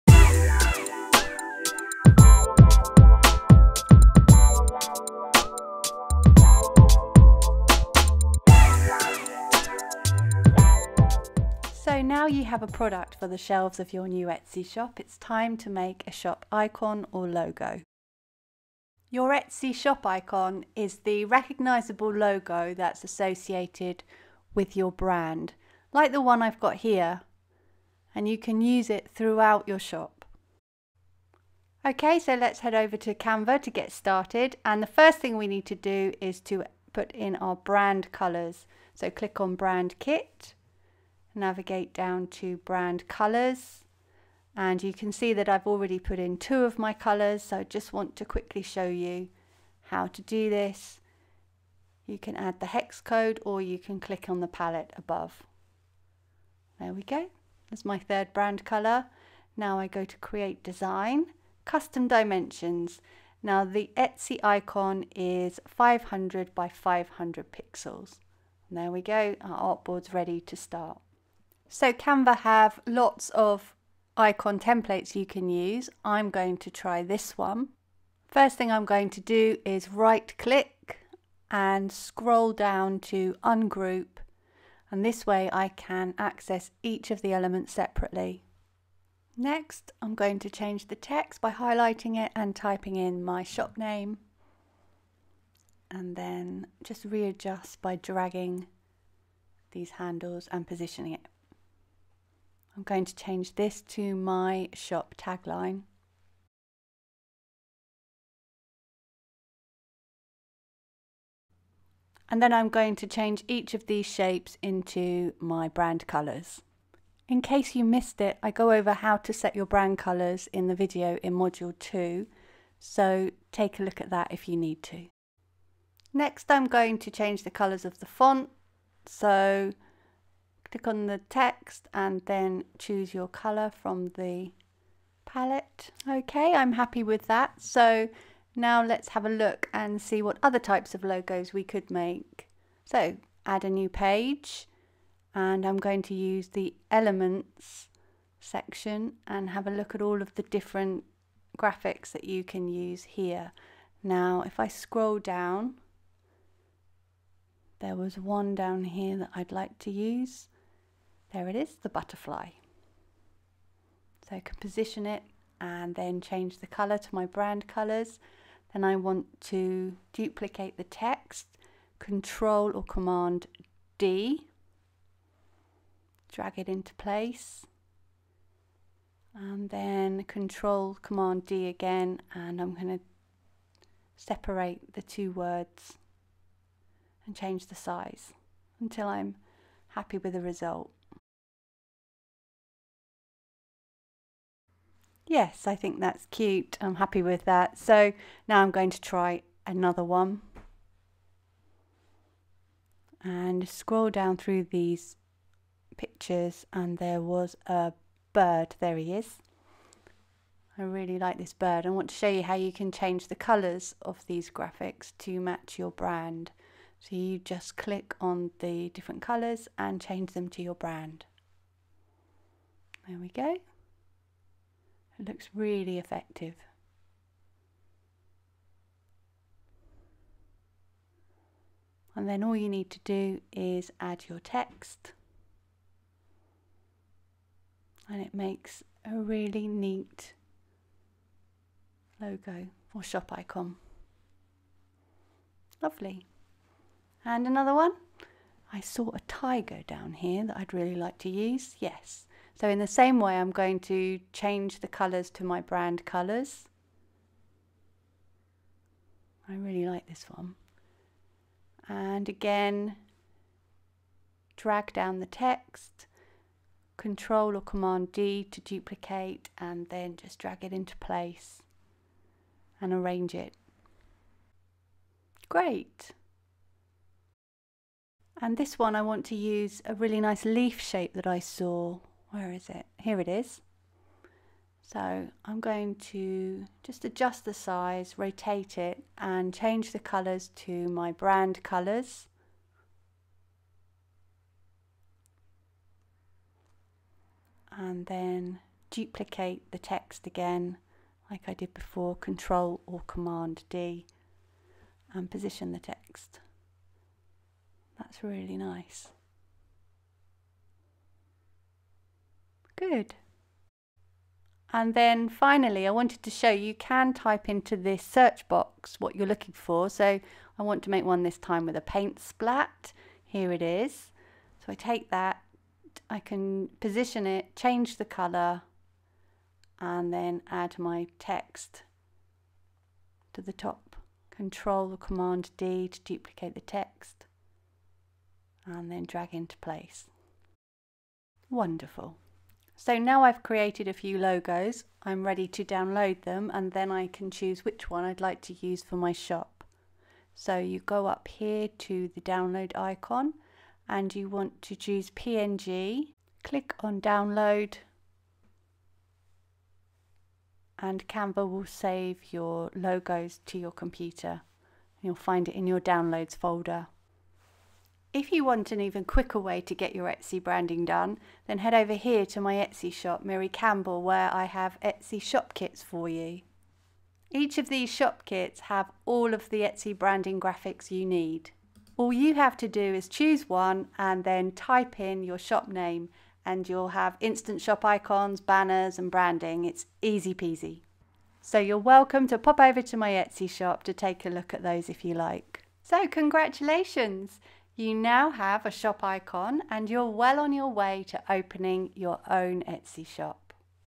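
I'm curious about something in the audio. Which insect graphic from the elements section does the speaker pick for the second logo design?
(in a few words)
butterfly.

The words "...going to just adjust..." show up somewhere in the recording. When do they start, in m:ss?
4:45.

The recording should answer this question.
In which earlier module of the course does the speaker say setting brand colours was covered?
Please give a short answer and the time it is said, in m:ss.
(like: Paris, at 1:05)
Module 2, at 2:01.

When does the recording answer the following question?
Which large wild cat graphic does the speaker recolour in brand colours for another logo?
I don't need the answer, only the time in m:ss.
4:09.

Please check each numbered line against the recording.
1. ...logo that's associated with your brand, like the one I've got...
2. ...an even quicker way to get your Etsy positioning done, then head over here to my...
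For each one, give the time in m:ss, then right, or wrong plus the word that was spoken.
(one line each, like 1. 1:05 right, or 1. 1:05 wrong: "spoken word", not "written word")
1. 0:22 right
2. 6:08 wrong: "branding", not "positioning".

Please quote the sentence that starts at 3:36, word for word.
So you just click on the different colours and change them to your brand.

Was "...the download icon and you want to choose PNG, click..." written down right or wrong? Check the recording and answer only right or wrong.
right.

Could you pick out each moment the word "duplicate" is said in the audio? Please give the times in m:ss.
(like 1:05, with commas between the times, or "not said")
2:50, 4:28, 4:58, 5:36.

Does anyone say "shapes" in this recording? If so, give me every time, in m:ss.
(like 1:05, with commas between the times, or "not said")
1:54, 4:40.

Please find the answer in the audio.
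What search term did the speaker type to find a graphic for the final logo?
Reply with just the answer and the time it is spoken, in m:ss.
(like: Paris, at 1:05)
paint splat, at 5:21.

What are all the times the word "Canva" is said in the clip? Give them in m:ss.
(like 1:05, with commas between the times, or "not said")
0:33, 1:11, 6:01.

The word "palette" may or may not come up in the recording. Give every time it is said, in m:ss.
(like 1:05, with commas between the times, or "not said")
0:54, 2:15.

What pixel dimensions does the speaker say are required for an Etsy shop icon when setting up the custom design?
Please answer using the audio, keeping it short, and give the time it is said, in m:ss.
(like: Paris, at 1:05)
500 by 500 pixels, at 1:05.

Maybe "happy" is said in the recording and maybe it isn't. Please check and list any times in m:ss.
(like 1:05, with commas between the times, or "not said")
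2:16, 3:09, 3:16.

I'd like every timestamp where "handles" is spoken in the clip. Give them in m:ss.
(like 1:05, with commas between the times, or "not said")
1:39.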